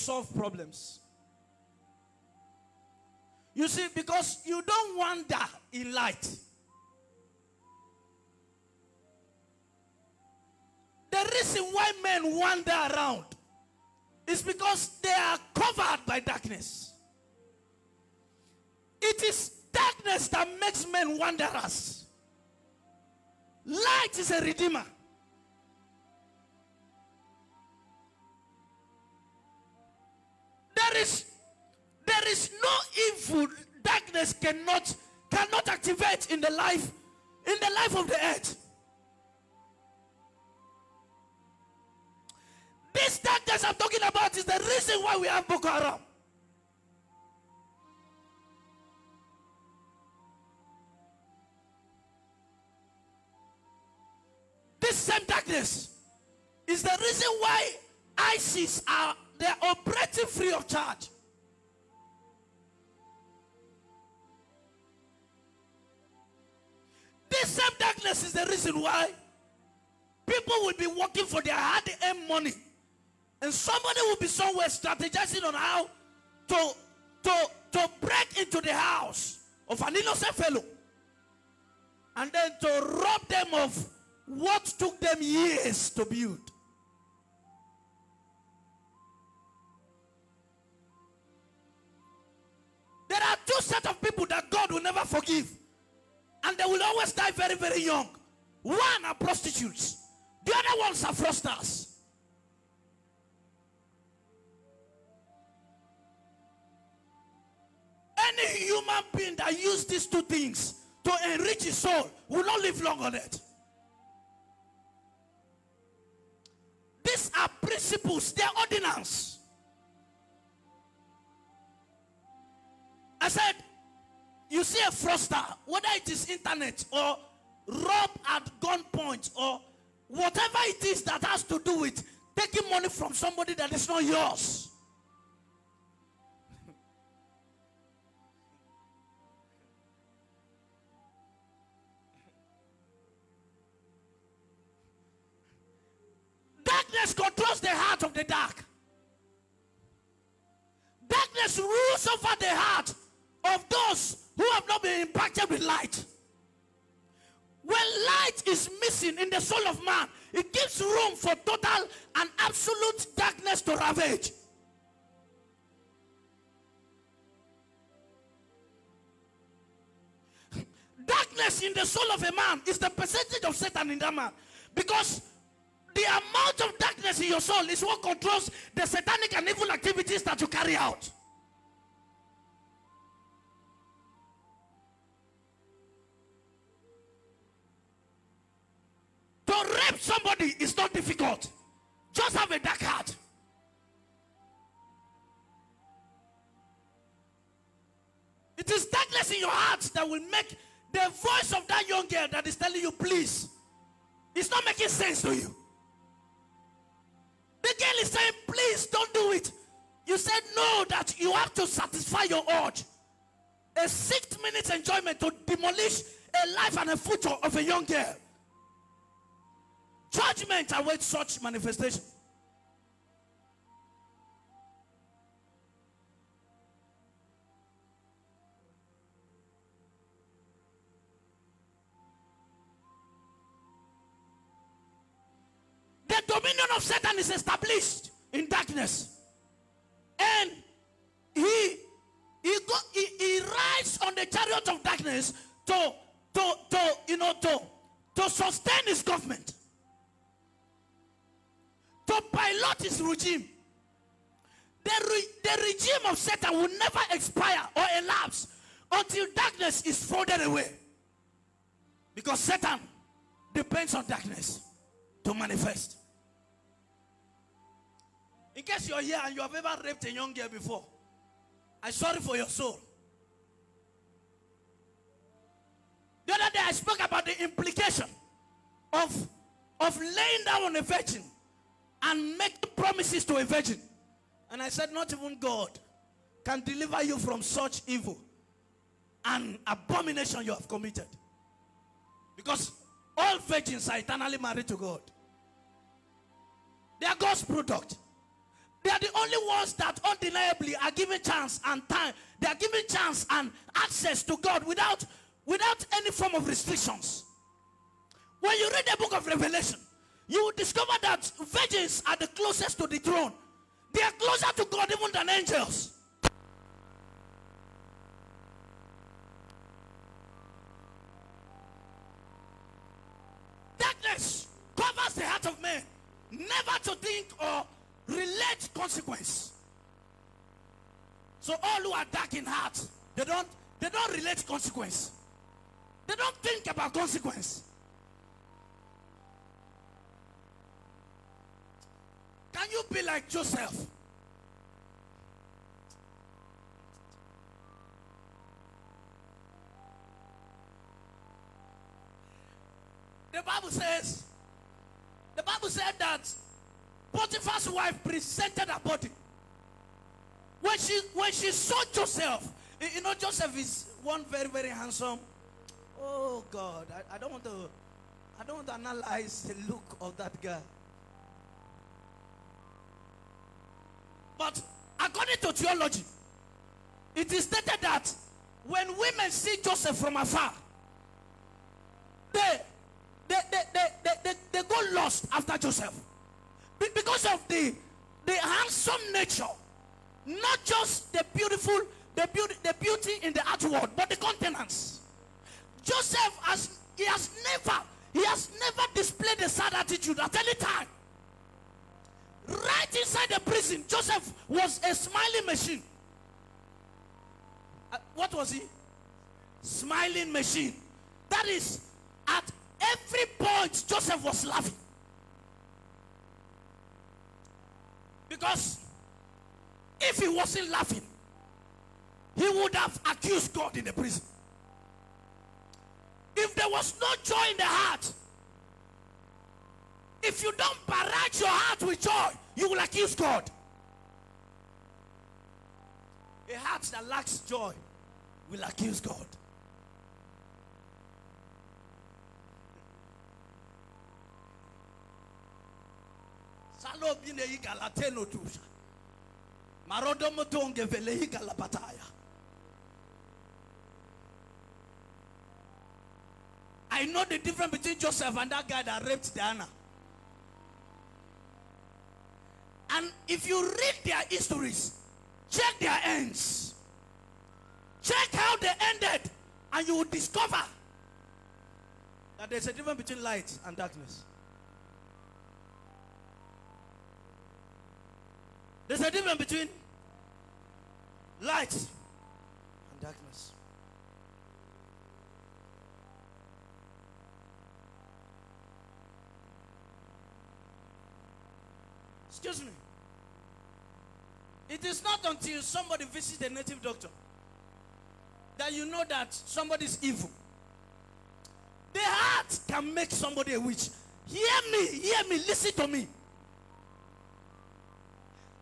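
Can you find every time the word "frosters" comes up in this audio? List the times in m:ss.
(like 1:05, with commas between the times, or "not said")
1:41, 2:04.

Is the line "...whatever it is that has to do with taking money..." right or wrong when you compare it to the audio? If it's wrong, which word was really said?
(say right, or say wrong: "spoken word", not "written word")
right.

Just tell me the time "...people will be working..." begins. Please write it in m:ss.
1:10.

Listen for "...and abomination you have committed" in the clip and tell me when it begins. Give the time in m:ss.
4:49.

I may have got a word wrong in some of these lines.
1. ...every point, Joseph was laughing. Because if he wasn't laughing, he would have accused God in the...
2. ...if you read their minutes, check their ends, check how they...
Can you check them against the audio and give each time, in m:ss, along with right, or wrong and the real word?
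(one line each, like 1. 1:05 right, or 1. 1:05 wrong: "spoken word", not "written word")
1. 6:52 right
2. 7:43 wrong: "histories", not "minutes".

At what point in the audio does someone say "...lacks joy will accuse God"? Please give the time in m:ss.
7:17.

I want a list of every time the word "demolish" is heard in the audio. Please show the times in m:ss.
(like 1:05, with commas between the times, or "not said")
3:35.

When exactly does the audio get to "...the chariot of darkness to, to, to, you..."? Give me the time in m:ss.
4:04.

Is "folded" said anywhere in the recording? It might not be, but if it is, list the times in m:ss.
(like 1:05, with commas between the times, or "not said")
4:20.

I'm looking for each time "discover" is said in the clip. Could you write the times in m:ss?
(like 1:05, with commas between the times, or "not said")
5:10, 7:50.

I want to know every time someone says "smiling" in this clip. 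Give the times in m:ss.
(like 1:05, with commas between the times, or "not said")
6:44, 6:49.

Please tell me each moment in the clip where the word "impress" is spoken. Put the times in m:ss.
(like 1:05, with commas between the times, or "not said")
not said.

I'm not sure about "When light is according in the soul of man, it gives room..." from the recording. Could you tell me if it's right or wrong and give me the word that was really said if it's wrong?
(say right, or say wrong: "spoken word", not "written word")
wrong: "missing", not "according".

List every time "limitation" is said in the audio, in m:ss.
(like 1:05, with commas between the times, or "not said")
not said.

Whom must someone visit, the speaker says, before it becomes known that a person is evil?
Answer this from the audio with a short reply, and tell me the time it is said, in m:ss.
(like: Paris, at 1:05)
The native doctor, at 8:16.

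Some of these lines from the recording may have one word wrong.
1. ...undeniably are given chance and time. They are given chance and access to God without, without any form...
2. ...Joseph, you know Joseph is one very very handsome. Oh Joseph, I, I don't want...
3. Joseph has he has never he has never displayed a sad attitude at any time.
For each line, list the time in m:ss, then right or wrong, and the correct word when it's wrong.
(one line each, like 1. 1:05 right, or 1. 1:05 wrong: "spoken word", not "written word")
1. 5:00 right
2. 6:01 wrong: "God", not "Joseph"
3. 6:35 right.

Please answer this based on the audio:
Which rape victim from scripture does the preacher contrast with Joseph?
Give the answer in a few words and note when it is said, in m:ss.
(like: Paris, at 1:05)
Diana, at 7:39.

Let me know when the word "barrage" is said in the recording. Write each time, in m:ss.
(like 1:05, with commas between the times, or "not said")
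7:10.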